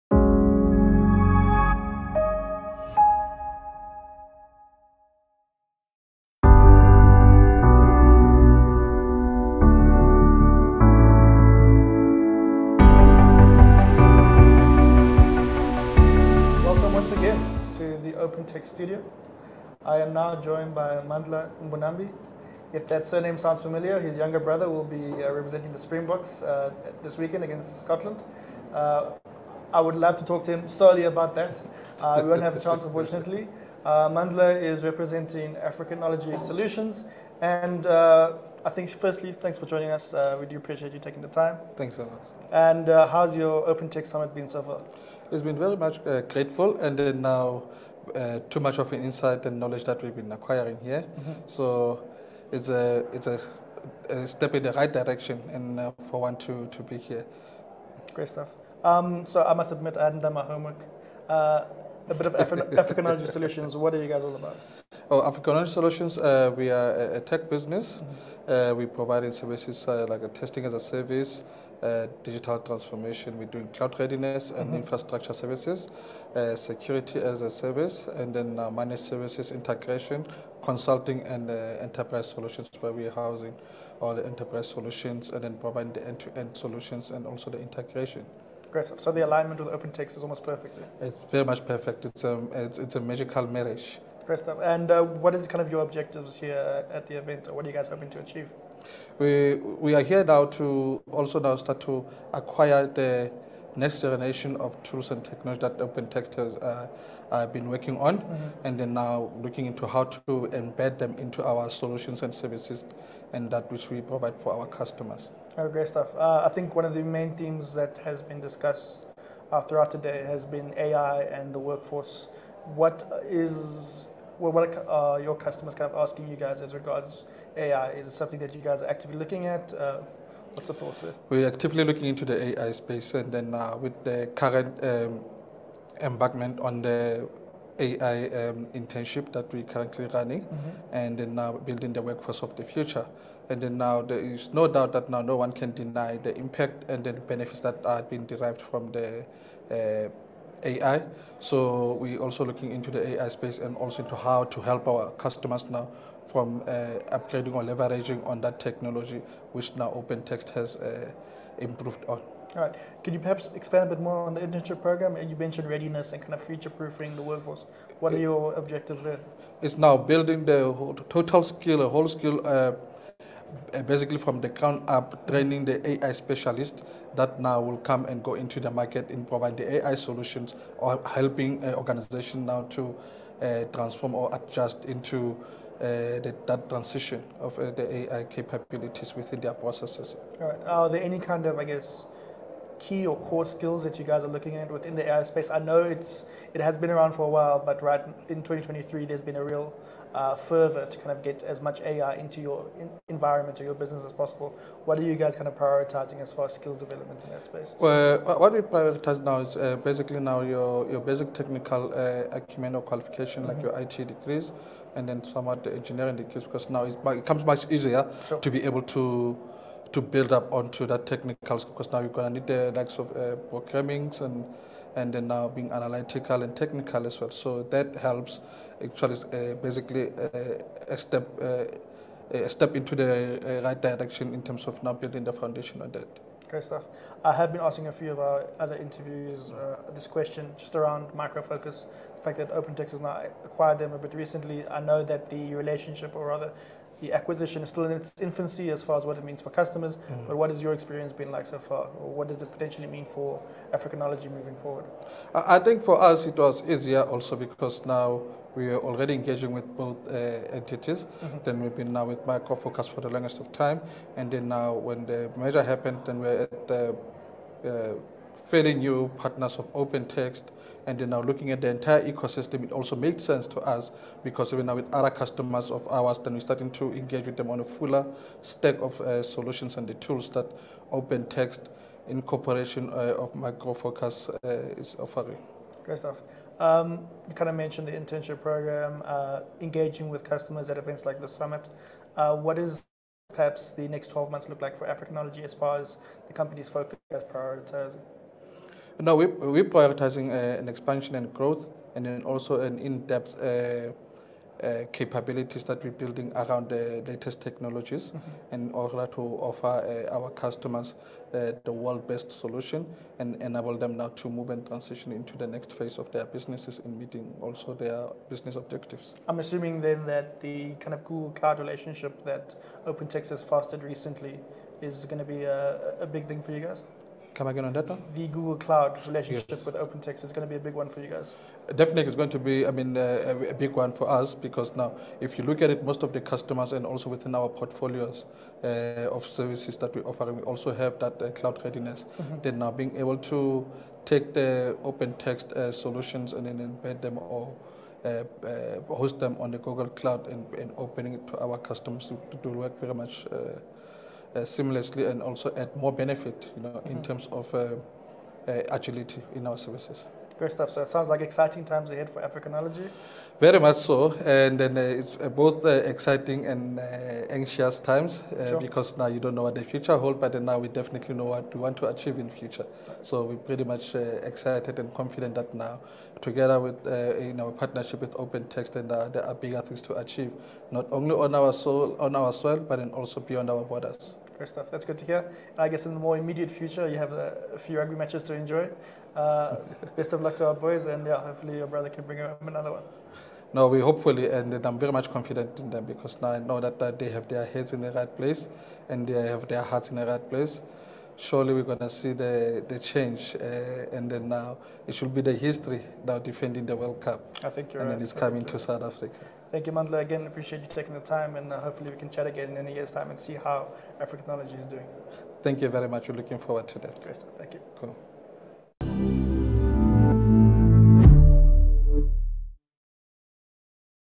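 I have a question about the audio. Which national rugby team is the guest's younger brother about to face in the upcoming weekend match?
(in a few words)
Scotland.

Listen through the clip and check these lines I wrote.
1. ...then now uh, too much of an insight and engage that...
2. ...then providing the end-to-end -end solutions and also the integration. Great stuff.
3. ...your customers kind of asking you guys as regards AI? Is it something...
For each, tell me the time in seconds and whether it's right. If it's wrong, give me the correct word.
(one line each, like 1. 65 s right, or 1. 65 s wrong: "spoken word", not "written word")
1. 46 s wrong: "knowledge", not "engage"
2. 85 s right
3. 125 s right.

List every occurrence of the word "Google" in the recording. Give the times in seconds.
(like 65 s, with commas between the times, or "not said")
321 s, 328 s, 349 s.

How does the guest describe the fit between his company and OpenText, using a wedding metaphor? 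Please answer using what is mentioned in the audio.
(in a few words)
magical marriage.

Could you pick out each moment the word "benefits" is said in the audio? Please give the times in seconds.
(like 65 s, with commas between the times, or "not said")
147 s, 355 s.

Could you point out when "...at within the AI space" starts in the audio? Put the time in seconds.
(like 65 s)
194 s.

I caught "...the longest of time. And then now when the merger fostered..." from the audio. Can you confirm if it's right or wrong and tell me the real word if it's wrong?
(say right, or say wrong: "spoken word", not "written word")
wrong: "happened", not "fostered".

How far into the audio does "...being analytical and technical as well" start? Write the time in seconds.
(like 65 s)
225 s.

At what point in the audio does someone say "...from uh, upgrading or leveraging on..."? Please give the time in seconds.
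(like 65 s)
156 s.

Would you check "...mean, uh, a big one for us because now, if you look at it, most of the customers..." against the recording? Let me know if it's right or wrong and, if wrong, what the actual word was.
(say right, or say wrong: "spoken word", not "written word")
right.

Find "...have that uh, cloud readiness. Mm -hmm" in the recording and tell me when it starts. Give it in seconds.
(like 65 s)
340 s.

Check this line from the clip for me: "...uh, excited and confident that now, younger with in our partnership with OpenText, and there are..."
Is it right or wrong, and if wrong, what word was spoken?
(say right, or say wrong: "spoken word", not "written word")
wrong: "together", not "younger".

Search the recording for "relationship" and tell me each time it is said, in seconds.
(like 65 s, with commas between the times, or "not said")
245 s, 321 s, 329 s.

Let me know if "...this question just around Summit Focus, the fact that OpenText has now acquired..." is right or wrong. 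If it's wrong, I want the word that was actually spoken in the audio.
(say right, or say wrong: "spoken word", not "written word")
wrong: "Micro", not "Summit".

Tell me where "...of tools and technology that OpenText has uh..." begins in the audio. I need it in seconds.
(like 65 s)
104 s.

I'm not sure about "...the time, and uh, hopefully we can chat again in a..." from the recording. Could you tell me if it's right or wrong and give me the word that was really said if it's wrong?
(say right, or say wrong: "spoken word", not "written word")
right.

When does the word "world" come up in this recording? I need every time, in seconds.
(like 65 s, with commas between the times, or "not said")
311 s, 406 s.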